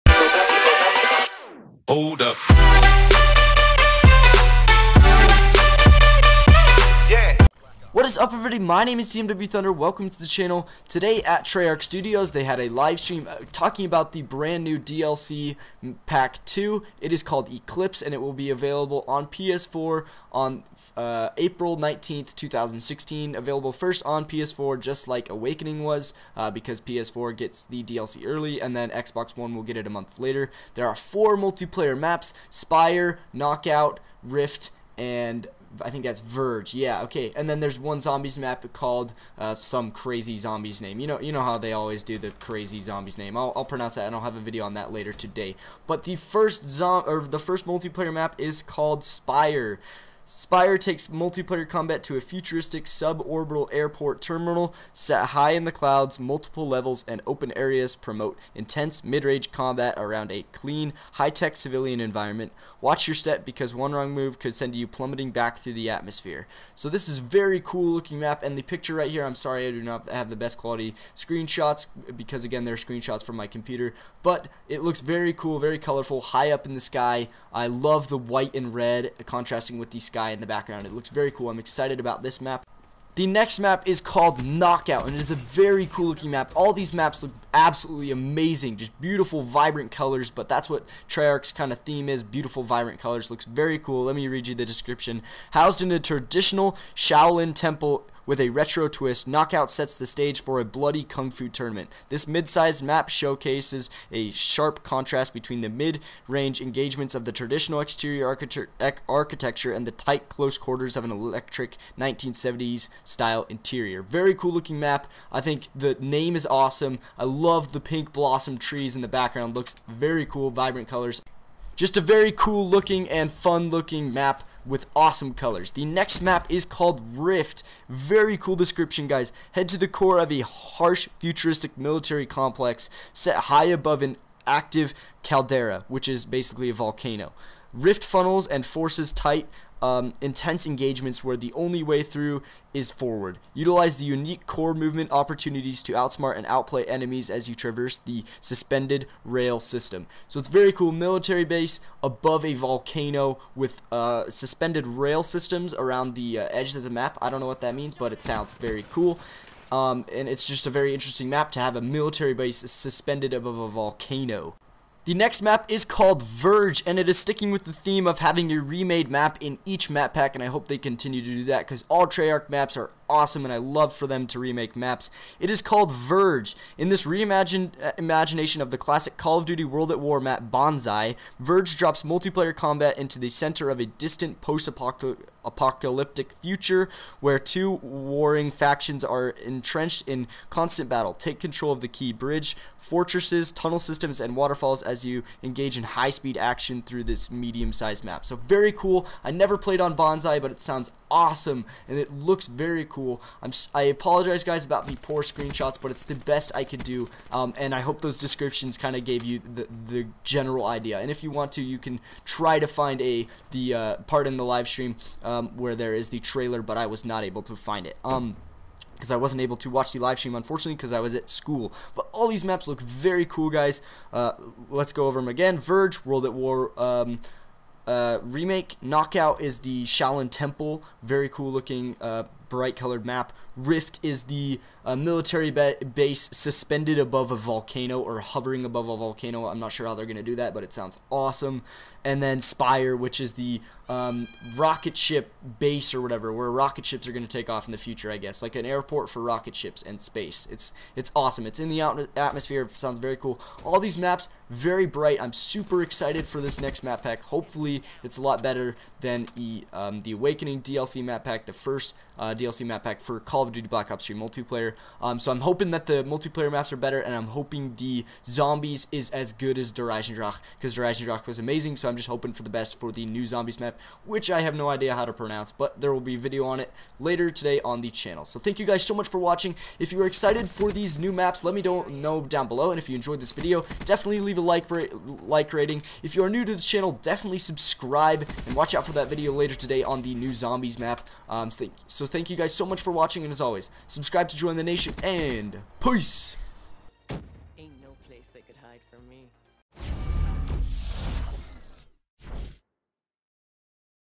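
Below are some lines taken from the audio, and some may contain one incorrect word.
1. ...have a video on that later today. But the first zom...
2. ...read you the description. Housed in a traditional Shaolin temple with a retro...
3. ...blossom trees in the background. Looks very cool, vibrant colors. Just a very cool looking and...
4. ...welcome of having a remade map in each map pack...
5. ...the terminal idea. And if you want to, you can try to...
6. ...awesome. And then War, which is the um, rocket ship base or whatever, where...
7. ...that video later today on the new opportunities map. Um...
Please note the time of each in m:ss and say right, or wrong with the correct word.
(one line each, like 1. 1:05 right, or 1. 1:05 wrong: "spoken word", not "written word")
1. 0:44 right
2. 1:34 right
3. 1:58 right
4. 2:47 wrong: "theme", not "welcome"
5. 3:29 wrong: "general", not "terminal"
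6. 4:01 wrong: "Spire", not "War"
7. 4:48 wrong: "zombies", not "opportunities".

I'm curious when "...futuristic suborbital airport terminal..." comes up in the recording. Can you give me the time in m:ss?
0:52.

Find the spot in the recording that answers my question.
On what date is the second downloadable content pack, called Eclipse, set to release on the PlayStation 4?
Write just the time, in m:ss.
0:21.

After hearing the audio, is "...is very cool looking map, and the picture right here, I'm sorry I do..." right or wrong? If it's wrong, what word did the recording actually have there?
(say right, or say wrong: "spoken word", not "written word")
right.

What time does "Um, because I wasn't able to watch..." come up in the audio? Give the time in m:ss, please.
3:38.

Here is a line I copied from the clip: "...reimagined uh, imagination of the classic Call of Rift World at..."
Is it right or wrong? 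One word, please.
wrong.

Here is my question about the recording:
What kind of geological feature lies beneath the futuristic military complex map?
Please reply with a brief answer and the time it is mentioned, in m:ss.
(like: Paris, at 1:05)
an active caldera, at 2:14.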